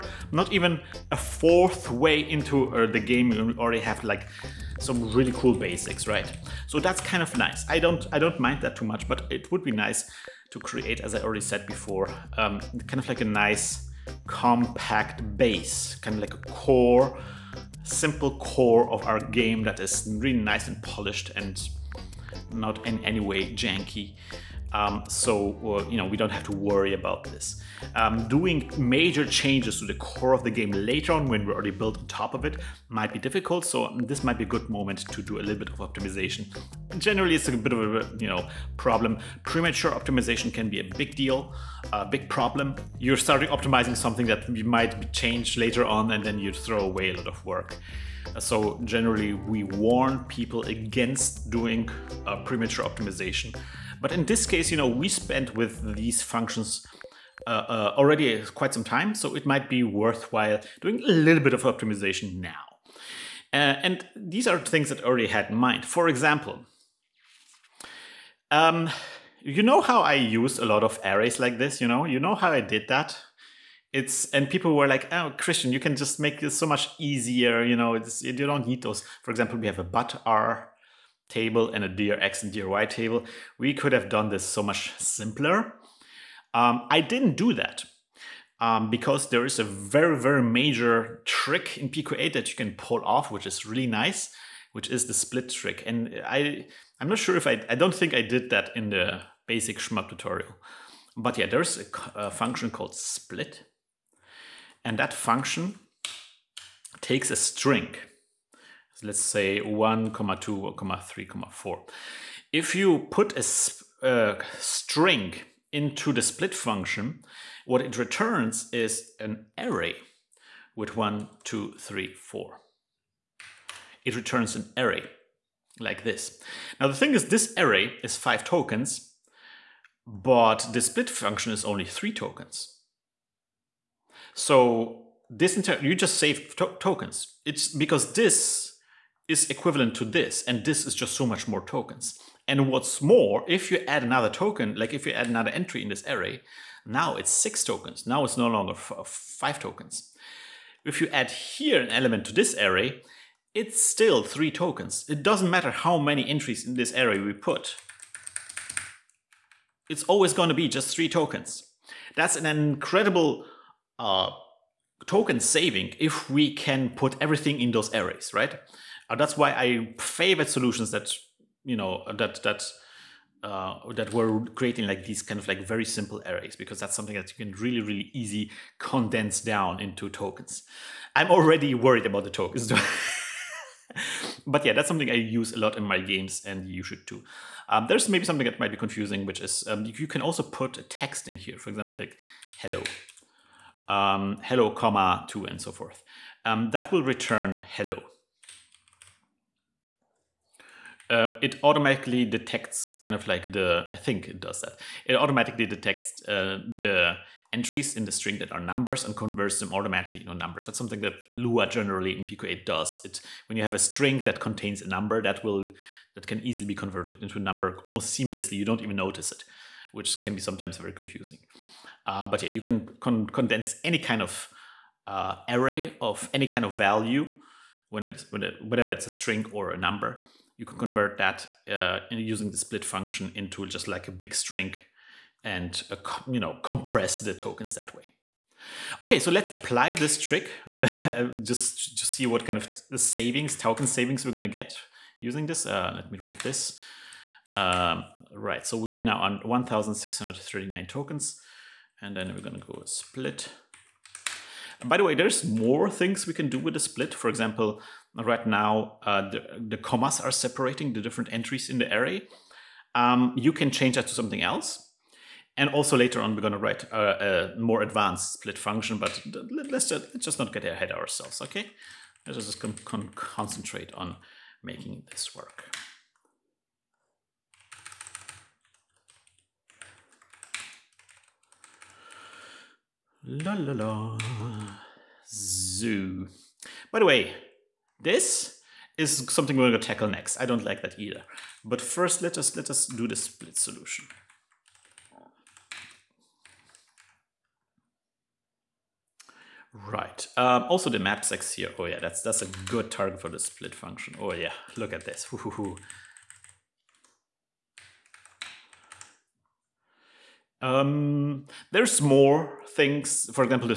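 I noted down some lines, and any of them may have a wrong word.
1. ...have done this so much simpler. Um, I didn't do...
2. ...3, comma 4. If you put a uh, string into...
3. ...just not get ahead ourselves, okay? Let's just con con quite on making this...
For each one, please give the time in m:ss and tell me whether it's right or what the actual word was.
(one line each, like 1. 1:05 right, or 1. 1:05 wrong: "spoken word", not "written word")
1. 1:23 right
2. 1:51 right
3. 4:30 wrong: "concentrate", not "quite".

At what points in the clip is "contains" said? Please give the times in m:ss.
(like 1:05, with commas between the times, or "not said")
3:34.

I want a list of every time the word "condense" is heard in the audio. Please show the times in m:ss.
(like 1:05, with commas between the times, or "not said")
2:58, 3:43.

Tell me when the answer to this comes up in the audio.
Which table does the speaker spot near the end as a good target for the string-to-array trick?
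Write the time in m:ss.
5:00.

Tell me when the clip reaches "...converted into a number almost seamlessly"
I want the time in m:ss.
3:36.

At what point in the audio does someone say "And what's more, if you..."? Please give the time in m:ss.
2:22.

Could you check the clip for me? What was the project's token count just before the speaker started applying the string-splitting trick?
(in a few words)
1,639.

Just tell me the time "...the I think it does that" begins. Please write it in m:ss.
3:23.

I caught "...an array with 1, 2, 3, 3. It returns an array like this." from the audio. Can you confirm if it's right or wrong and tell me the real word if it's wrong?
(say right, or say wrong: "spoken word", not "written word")
wrong: "4", not "3".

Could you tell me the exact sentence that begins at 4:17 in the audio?
For example, right now uh, the, the, commas are separating the different entries in the array.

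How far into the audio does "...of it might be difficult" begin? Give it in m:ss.
0:32.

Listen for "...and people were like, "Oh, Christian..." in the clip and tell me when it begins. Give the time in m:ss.
1:14.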